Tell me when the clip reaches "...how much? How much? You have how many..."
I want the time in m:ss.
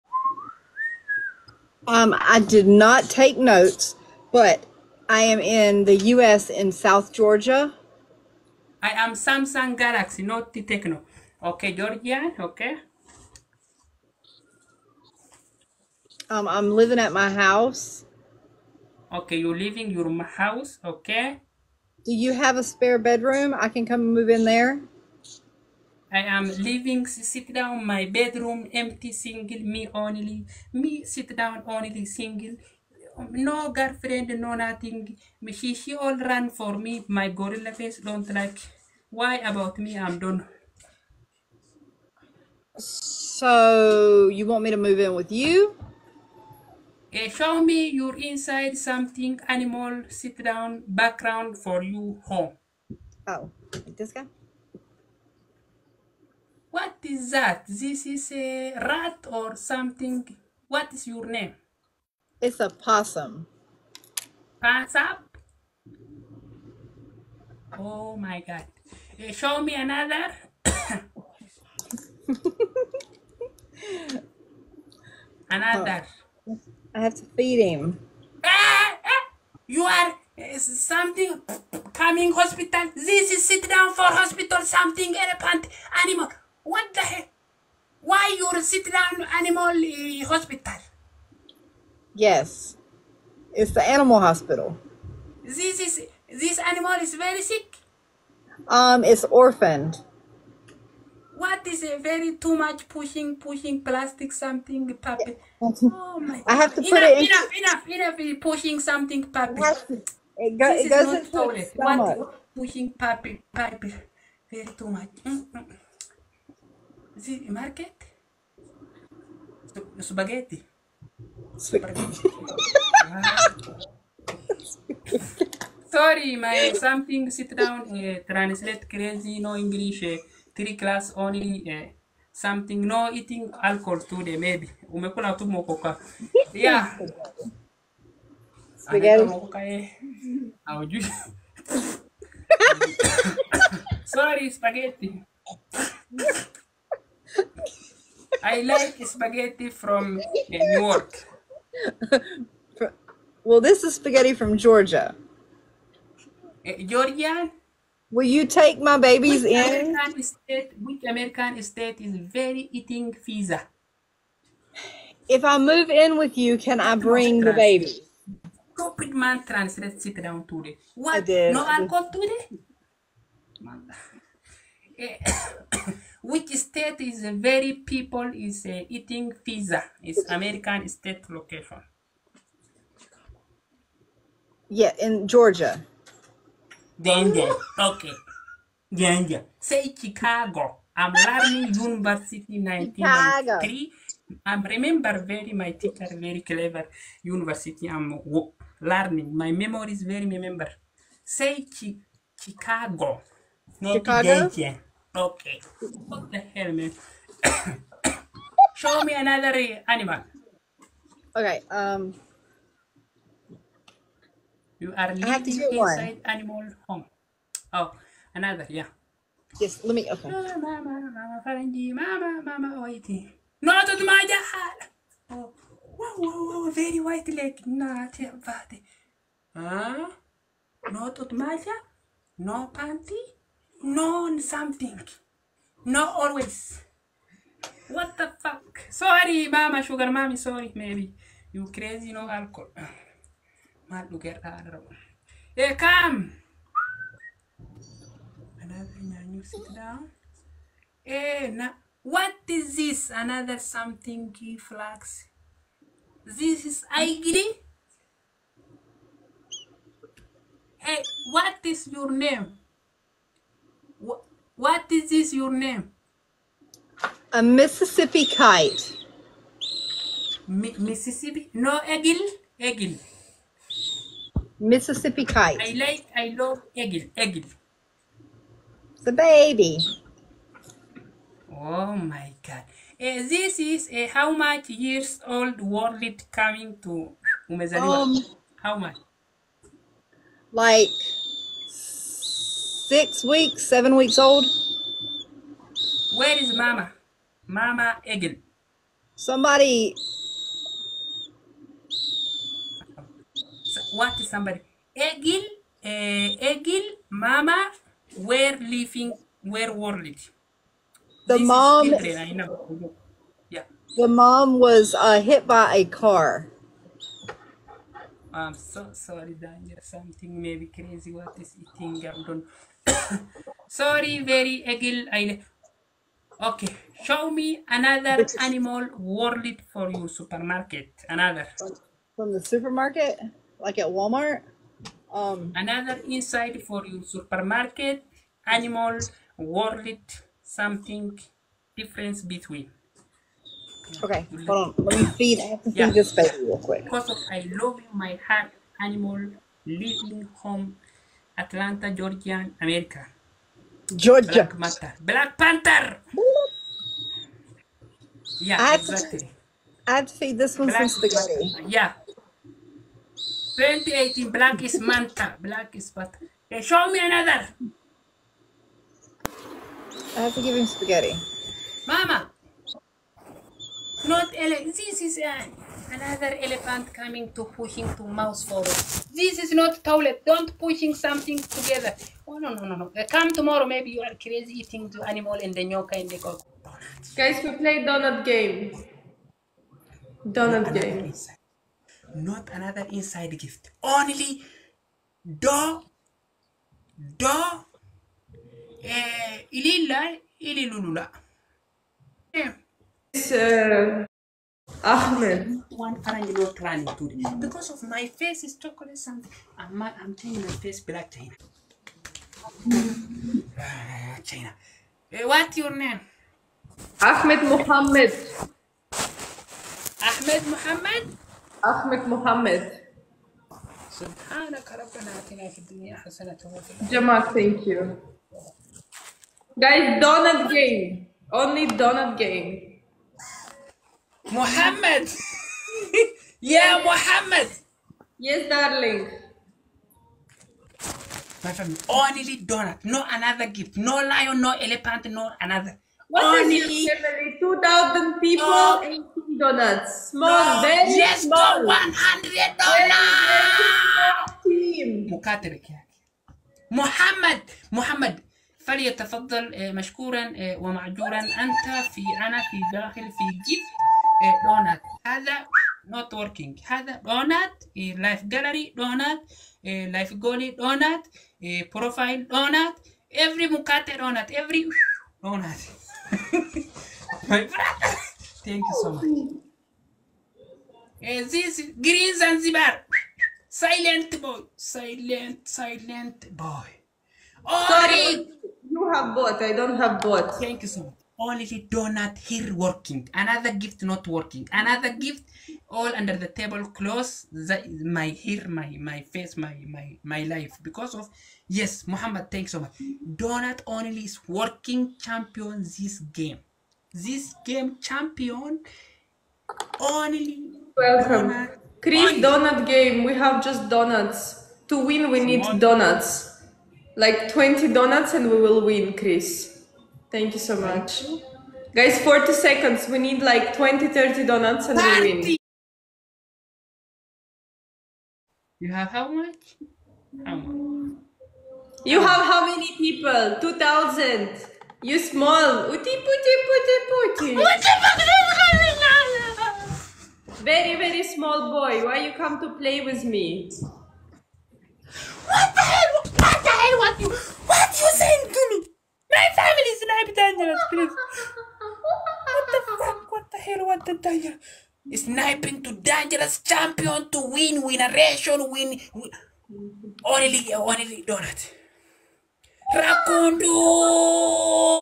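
8:48.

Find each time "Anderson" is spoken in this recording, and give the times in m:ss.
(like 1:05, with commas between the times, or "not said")
not said.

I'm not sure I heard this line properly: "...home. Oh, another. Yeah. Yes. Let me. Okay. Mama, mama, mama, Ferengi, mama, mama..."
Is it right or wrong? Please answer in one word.
right.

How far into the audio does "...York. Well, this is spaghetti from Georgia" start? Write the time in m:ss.
2:30.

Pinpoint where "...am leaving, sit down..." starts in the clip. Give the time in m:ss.
0:26.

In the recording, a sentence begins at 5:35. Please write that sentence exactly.
Another insight for you, supermarket, animal, worlded, something, difference between.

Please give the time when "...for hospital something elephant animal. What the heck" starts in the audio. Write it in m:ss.
1:23.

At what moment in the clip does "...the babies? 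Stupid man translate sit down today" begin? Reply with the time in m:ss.
2:47.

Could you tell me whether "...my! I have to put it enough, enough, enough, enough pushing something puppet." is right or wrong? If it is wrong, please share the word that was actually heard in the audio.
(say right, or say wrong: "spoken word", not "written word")
right.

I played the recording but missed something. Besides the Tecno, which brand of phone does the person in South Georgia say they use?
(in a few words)
Samsung Galaxy.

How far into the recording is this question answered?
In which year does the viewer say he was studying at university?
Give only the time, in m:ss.
3:12.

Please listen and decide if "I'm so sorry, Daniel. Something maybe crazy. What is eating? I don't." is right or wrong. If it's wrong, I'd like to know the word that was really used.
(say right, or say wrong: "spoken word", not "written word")
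right.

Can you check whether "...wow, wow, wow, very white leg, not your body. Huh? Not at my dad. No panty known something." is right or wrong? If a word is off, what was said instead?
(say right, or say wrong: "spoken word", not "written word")
right.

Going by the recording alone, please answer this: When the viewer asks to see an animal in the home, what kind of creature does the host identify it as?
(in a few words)
Possum.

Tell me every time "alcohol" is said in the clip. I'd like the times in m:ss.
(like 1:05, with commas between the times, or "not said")
2:13, 2:51, 4:02.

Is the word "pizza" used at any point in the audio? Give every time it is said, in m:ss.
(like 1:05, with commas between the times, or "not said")
2:43, 2:59.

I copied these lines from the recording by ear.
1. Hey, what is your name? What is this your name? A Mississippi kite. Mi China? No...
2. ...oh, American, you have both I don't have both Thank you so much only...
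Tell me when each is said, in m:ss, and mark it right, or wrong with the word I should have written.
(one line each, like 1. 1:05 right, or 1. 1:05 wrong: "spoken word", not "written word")
1. 4:20 wrong: "Mississippi", not "China"
2. 8:07 wrong: "Sorry", not "American".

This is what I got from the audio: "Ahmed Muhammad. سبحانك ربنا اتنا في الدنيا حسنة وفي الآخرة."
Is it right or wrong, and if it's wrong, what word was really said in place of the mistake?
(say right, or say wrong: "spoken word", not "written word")
right.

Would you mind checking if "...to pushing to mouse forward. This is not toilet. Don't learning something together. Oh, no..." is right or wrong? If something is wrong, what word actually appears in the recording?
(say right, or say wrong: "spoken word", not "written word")
wrong: "pushing", not "learning".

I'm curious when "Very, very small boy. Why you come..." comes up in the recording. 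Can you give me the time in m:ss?
9:00.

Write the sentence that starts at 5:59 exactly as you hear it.
i feed this one Black, some spaghetti.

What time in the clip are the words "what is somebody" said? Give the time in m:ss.
5:03.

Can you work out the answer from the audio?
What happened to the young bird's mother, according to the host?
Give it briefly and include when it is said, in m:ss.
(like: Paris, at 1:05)
Hit by a car, at 5:15.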